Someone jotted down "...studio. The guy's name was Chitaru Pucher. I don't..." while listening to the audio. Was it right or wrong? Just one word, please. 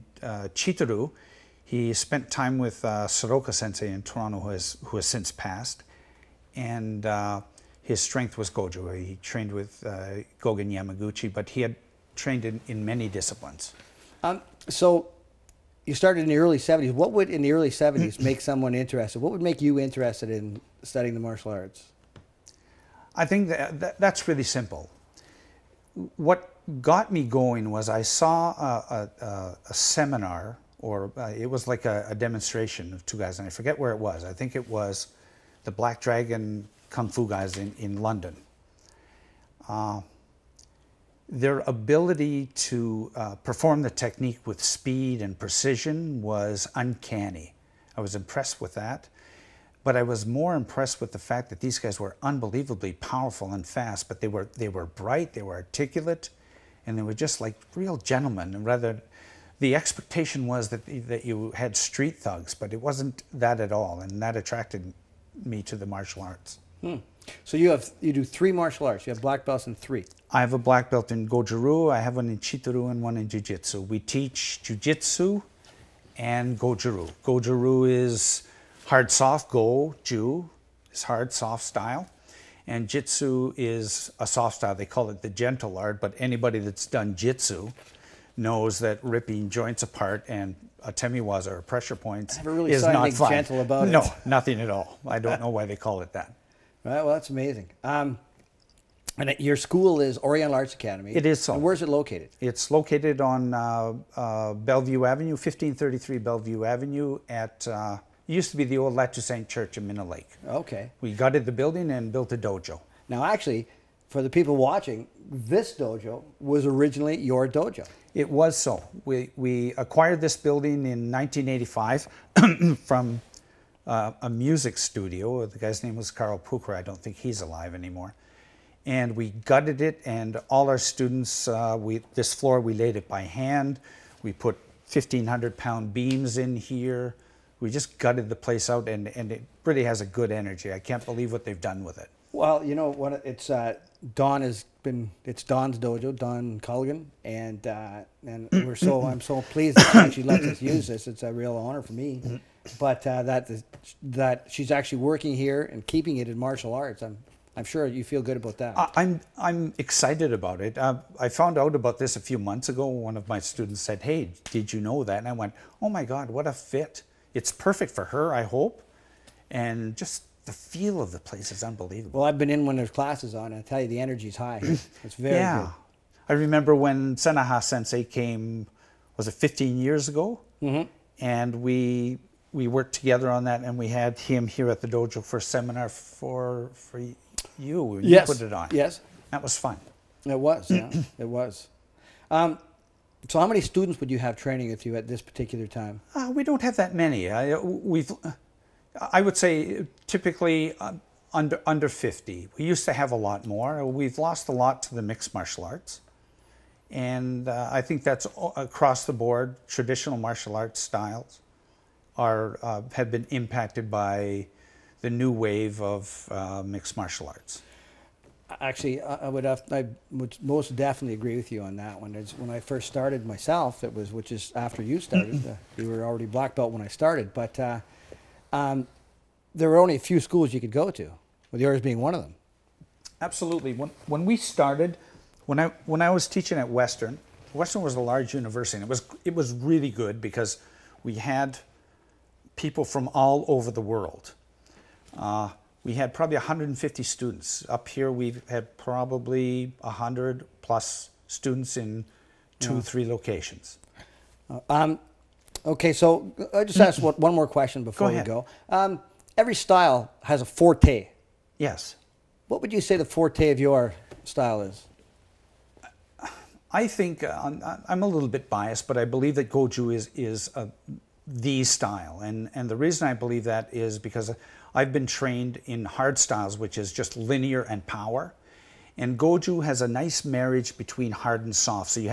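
wrong.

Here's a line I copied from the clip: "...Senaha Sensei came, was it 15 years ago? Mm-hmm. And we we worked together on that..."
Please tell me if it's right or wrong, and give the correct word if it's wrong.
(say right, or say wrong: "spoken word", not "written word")
right.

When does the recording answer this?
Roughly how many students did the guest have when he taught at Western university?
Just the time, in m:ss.
4:06.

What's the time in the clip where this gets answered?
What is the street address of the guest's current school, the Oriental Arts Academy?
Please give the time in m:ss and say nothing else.
1:45.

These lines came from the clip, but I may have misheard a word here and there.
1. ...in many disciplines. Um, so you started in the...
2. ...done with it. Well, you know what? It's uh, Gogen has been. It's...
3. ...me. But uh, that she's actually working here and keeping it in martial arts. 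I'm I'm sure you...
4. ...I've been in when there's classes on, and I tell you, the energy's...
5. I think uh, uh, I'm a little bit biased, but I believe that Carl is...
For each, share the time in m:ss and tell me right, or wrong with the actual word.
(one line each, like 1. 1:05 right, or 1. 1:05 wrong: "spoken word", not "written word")
1. 0:12 right
2. 2:21 wrong: "Don", not "Gogen"
3. 2:31 right
4. 2:52 right
5. 4:26 wrong: "Goju", not "Carl".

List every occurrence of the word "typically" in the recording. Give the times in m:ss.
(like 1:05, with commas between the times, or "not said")
3:20.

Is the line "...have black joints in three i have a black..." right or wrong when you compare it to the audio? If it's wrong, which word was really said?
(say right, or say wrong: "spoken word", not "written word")
wrong: "belts", not "joints".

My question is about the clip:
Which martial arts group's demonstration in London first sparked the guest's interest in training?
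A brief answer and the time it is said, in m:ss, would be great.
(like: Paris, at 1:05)
Black Dragon Kung Fu, at 0:35.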